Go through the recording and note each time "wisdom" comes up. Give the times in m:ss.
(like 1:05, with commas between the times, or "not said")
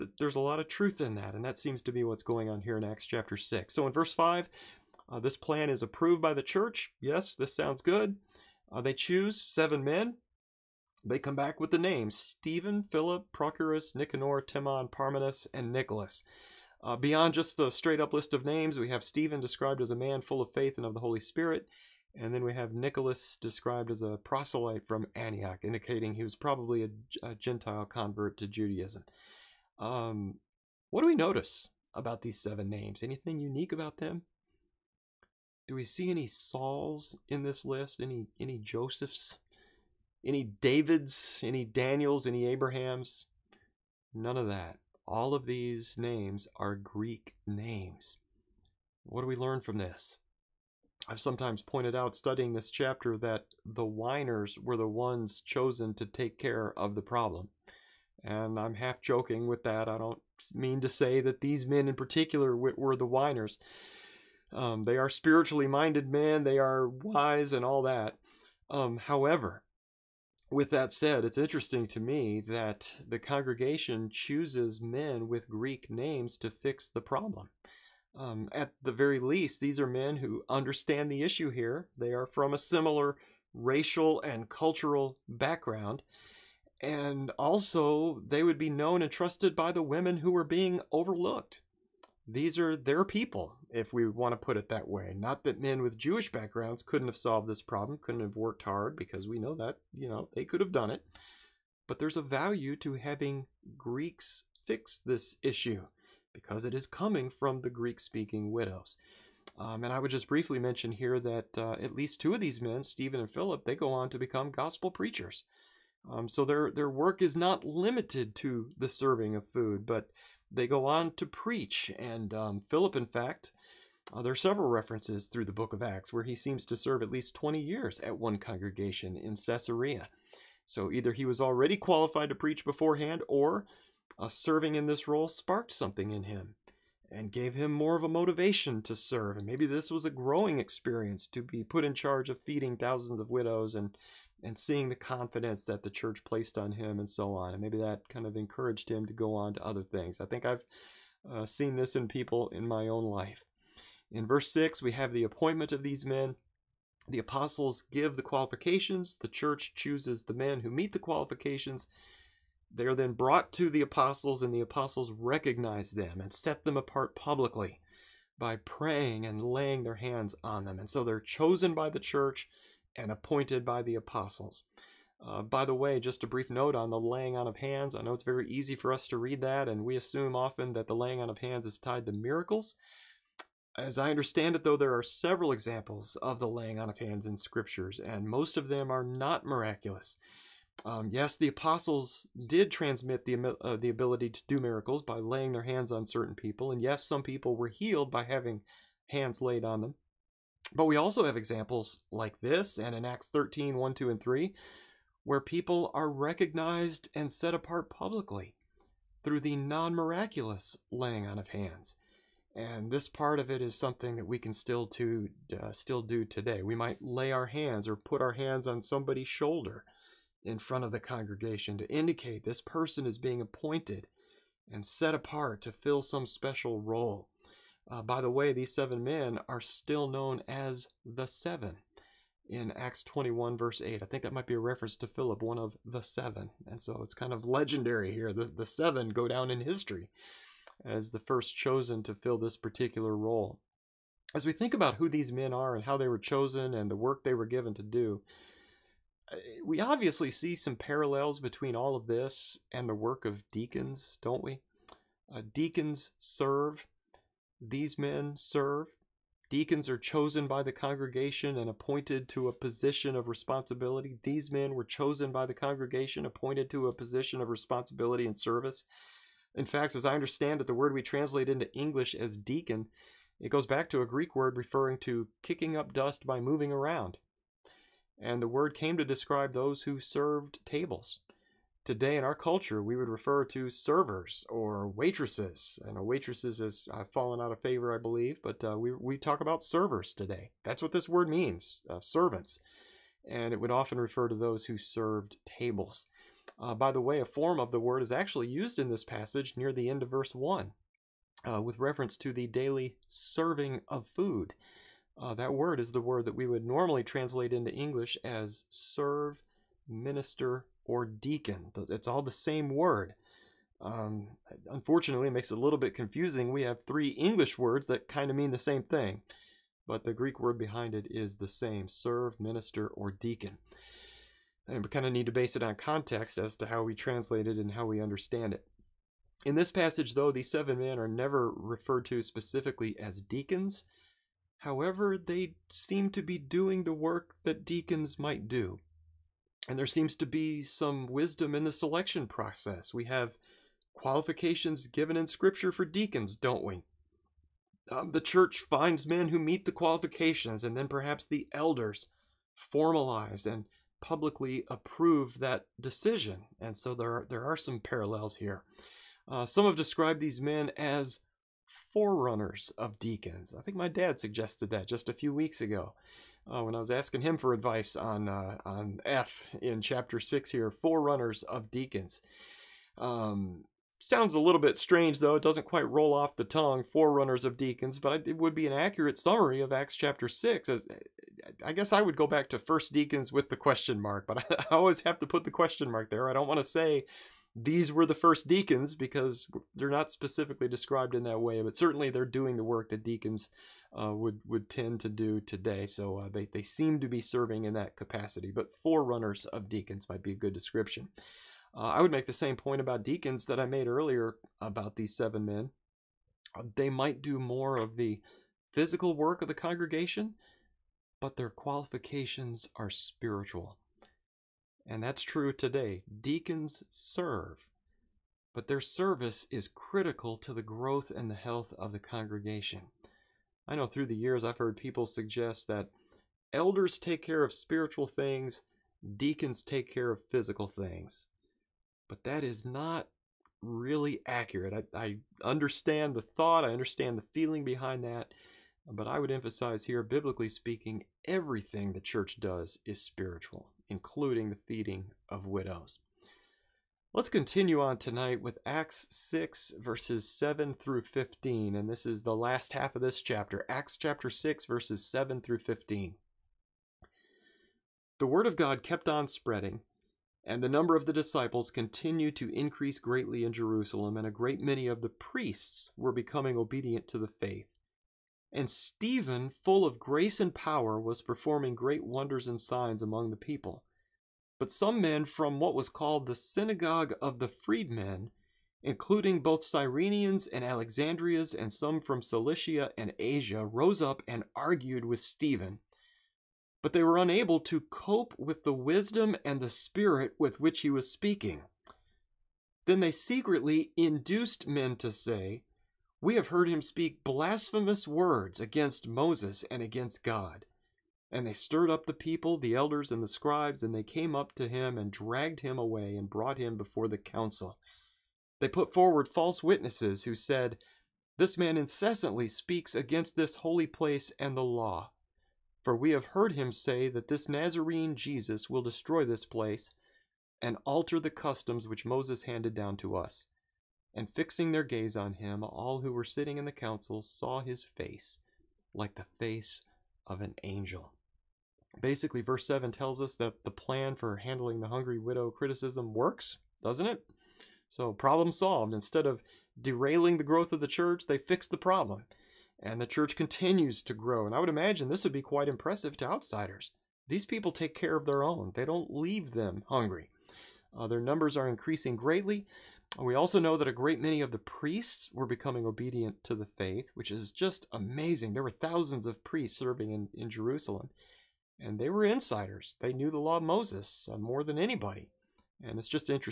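5:41, 8:08.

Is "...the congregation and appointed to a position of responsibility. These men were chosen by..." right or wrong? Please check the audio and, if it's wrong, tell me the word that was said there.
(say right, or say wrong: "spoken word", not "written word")
right.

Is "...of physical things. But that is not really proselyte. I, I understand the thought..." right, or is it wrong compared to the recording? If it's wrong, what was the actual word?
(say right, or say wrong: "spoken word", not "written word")
wrong: "accurate", not "proselyte".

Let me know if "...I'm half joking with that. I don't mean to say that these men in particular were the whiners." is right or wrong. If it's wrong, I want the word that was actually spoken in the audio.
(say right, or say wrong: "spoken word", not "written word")
right.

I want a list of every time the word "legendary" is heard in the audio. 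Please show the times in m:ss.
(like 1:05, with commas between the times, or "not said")
3:57.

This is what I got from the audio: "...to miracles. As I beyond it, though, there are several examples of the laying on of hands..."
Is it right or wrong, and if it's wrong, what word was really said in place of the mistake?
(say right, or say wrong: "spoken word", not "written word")
wrong: "understand", not "beyond".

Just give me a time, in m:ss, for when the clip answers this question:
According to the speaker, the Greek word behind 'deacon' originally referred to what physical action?
4:35.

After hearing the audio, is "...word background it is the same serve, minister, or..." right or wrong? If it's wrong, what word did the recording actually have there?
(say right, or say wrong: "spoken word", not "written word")
wrong: "behind", not "background".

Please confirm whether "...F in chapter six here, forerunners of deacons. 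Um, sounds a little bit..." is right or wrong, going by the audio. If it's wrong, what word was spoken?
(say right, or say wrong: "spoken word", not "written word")
right.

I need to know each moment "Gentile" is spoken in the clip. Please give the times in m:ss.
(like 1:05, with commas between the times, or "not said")
0:27.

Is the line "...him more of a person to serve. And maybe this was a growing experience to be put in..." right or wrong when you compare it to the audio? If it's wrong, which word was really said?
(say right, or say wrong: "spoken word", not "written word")
wrong: "motivation", not "person".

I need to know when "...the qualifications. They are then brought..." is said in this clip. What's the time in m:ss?
2:40.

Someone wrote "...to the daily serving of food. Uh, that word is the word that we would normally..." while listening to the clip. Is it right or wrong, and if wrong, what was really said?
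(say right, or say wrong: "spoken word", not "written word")
right.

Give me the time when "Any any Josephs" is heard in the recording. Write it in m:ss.
0:38.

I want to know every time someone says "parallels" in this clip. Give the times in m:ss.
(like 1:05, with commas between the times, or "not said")
4:10, 5:57.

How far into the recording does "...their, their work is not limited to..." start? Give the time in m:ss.
1:56.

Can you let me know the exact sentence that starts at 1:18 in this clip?
Um, at the very least, these are men who understand the issue here.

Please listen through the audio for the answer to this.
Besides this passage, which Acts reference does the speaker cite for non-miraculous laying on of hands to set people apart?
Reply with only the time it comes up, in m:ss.
3:23.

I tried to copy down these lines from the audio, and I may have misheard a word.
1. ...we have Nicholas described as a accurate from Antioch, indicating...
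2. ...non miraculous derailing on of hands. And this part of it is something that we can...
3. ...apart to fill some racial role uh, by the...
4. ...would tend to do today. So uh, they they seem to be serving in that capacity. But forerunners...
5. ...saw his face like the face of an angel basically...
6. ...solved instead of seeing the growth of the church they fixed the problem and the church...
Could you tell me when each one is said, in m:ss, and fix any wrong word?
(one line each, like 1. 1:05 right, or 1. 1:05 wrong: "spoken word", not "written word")
1. 0:22 wrong: "proselyte", not "accurate"
2. 3:29 wrong: "laying", not "derailing"
3. 3:45 wrong: "special", not "racial"
4. 6:34 right
5. 8:47 right
6. 8:58 wrong: "derailing", not "seeing".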